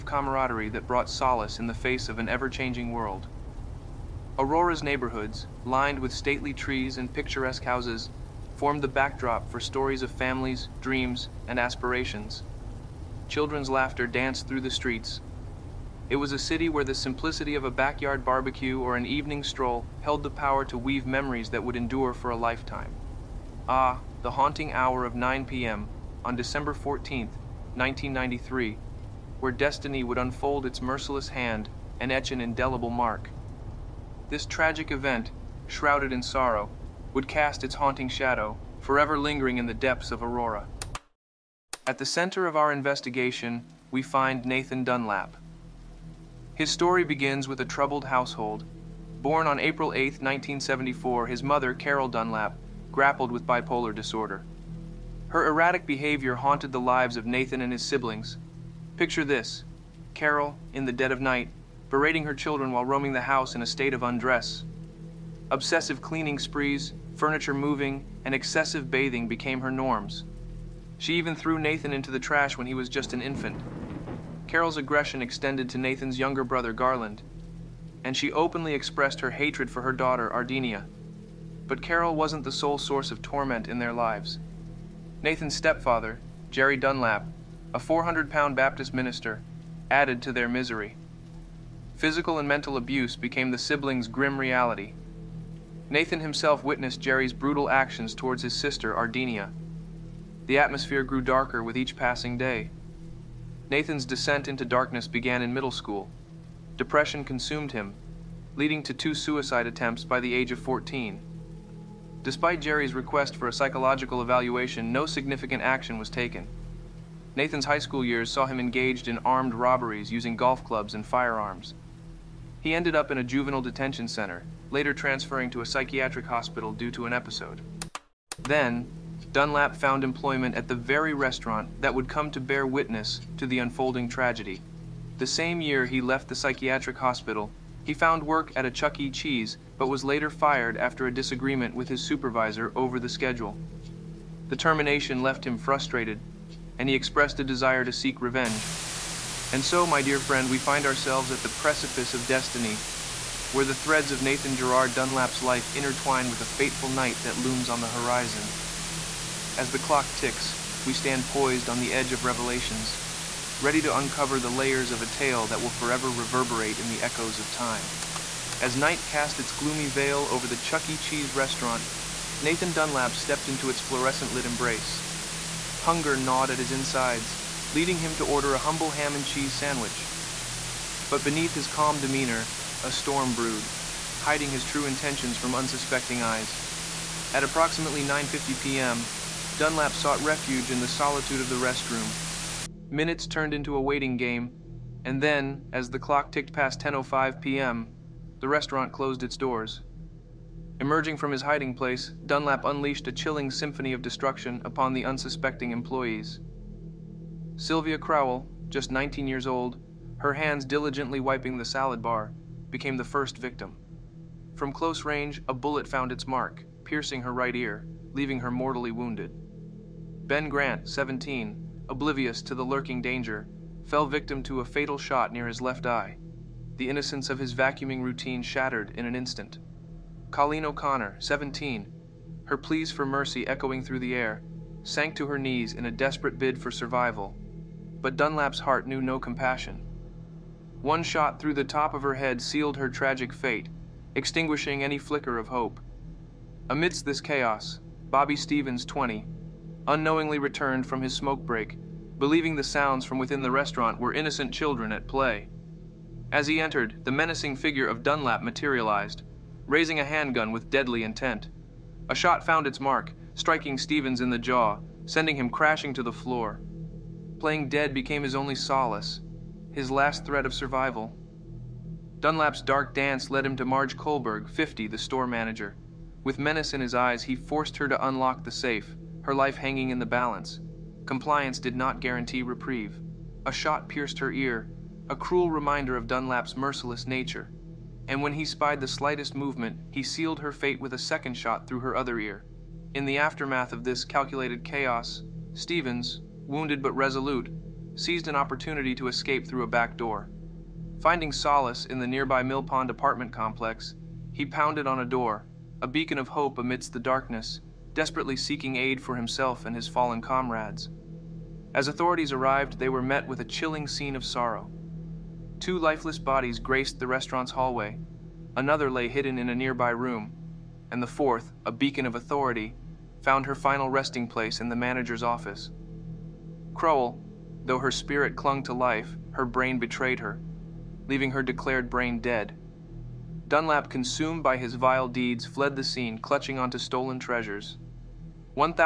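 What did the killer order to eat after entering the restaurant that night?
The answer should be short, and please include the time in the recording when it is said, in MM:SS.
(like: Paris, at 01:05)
ham and cheese sandwich, at 02:58.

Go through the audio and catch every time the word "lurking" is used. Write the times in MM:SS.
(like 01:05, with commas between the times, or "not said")
03:42.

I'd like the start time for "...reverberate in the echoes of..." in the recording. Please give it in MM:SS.
02:46.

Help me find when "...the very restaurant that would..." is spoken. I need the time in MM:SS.
02:10.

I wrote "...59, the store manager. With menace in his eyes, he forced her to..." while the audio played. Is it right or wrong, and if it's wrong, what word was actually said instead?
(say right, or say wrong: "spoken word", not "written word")
wrong: "50", not "59".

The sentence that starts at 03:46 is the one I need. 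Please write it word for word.
The innocence of his vacuuming routine shattered in an instant.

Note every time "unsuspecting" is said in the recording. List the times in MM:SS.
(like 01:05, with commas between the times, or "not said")
03:05, 03:25.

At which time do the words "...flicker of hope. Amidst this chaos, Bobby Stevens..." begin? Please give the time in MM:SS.
04:04.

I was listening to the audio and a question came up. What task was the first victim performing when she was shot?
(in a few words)
wiping the salad bar.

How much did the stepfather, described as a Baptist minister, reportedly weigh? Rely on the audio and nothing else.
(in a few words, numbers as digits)
400 pounds.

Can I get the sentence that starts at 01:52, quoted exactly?
Despite Jerry's request for a psychological evaluation, no significant action was taken.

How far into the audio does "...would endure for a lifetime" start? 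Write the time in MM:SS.
00:21.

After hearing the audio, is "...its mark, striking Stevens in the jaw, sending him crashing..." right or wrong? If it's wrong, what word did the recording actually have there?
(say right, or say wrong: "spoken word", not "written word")
right.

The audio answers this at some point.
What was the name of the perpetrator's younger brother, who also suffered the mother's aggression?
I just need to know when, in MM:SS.
01:16.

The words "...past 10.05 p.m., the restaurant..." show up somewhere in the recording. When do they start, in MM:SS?
03:16.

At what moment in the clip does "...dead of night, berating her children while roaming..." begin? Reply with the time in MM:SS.
01:00.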